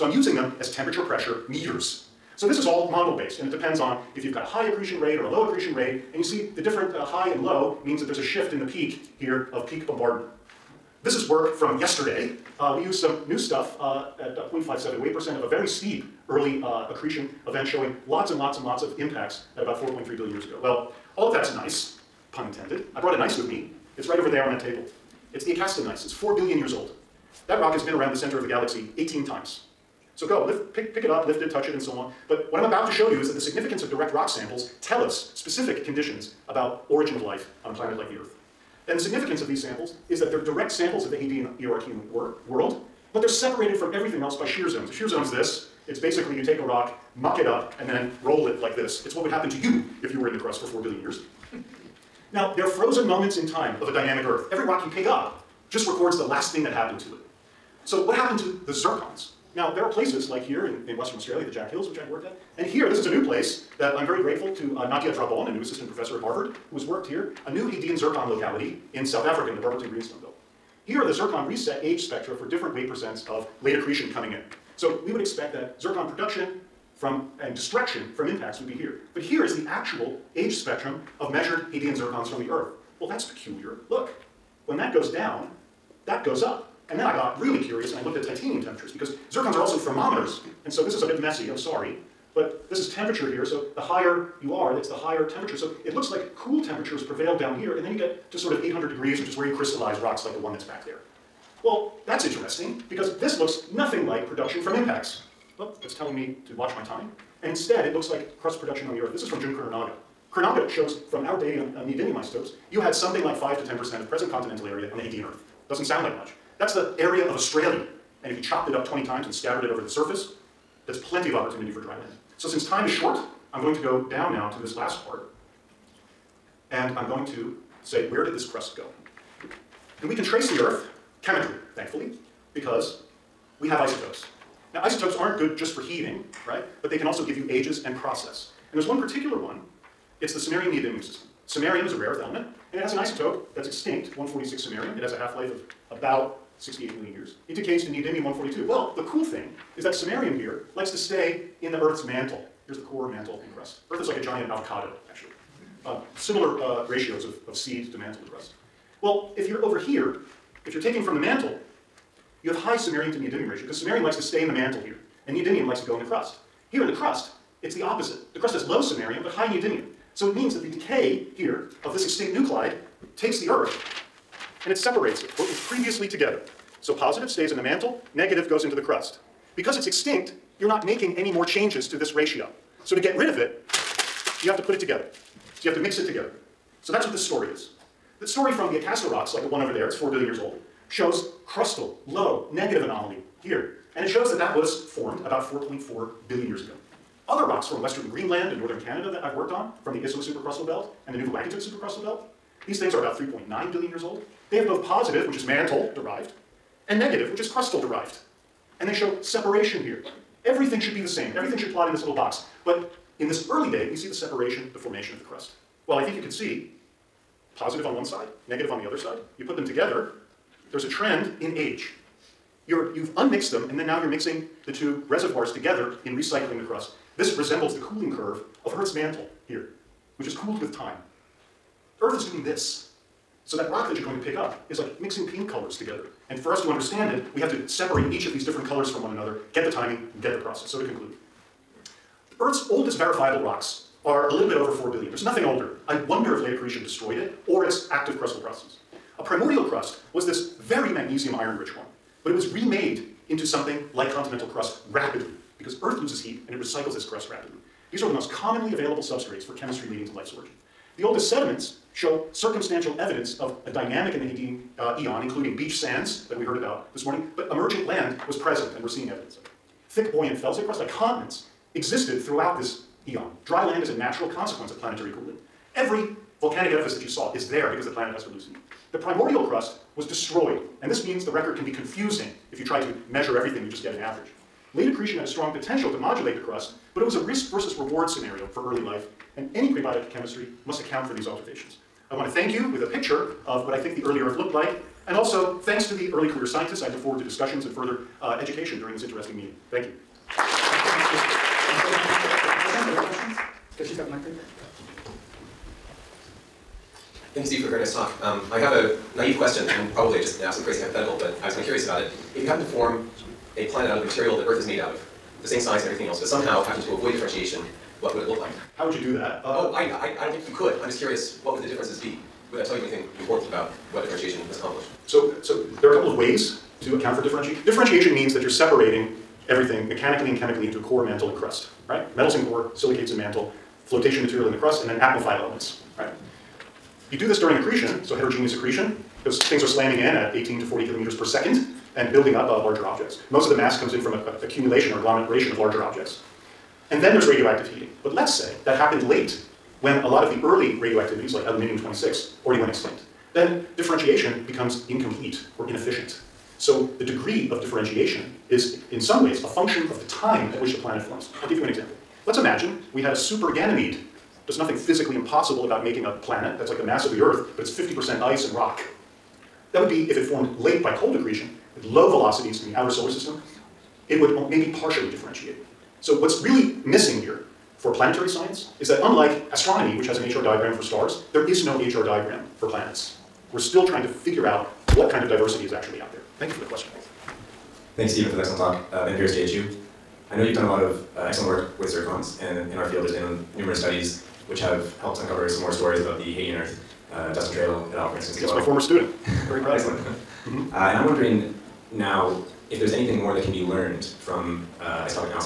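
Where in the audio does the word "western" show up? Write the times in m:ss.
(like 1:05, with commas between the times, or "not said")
1:00, 3:17.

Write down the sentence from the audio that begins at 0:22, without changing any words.
I brought a gneiss with me.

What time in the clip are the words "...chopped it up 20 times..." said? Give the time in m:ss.
1:58.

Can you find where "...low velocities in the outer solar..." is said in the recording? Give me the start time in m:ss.
6:11.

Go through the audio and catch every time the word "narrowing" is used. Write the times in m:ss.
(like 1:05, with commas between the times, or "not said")
not said.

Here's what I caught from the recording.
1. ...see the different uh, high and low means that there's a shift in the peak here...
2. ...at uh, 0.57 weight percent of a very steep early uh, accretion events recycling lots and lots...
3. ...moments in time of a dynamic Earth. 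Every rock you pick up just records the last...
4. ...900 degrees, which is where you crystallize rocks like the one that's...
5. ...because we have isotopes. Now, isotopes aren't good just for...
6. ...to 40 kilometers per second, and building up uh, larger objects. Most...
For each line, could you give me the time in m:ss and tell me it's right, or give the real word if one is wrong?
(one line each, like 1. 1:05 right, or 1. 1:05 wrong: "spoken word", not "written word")
1. 0:06 right
2. 0:14 wrong: "showing", not "recycling"
3. 0:53 right
4. 1:38 wrong: "800", not "900"
5. 2:12 right
6. 5:40 right.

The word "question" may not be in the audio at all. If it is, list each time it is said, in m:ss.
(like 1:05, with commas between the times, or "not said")
5:09, 6:26.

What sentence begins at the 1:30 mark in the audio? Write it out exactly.
And so this is a bit messy, I'm sorry.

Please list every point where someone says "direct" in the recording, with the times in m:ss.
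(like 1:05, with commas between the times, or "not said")
0:33, 0:40.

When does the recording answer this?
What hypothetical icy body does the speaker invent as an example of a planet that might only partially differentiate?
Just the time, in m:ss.
6:03.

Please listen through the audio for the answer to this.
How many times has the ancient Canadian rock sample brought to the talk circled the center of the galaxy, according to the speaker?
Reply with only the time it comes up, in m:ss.
0:28.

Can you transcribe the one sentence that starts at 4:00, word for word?
So to conclude, Earth's oldest verifiable rocks are a little bit over 4 billion.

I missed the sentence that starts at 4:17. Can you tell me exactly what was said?
These are the most commonly available substrates for chemistry leading to life's origin.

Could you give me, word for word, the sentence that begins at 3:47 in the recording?
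This resembles the cooling curve of Earth's mantle here, which is cooled with time.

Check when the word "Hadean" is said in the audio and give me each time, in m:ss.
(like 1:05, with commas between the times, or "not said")
0:41, 1:07, 1:21, 1:55, 4:24, 6:36.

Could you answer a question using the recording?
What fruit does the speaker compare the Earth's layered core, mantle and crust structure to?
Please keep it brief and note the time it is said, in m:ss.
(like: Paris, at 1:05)
avocado, at 2:34.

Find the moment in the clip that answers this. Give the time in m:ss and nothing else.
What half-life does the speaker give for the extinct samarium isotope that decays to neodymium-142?
2:26.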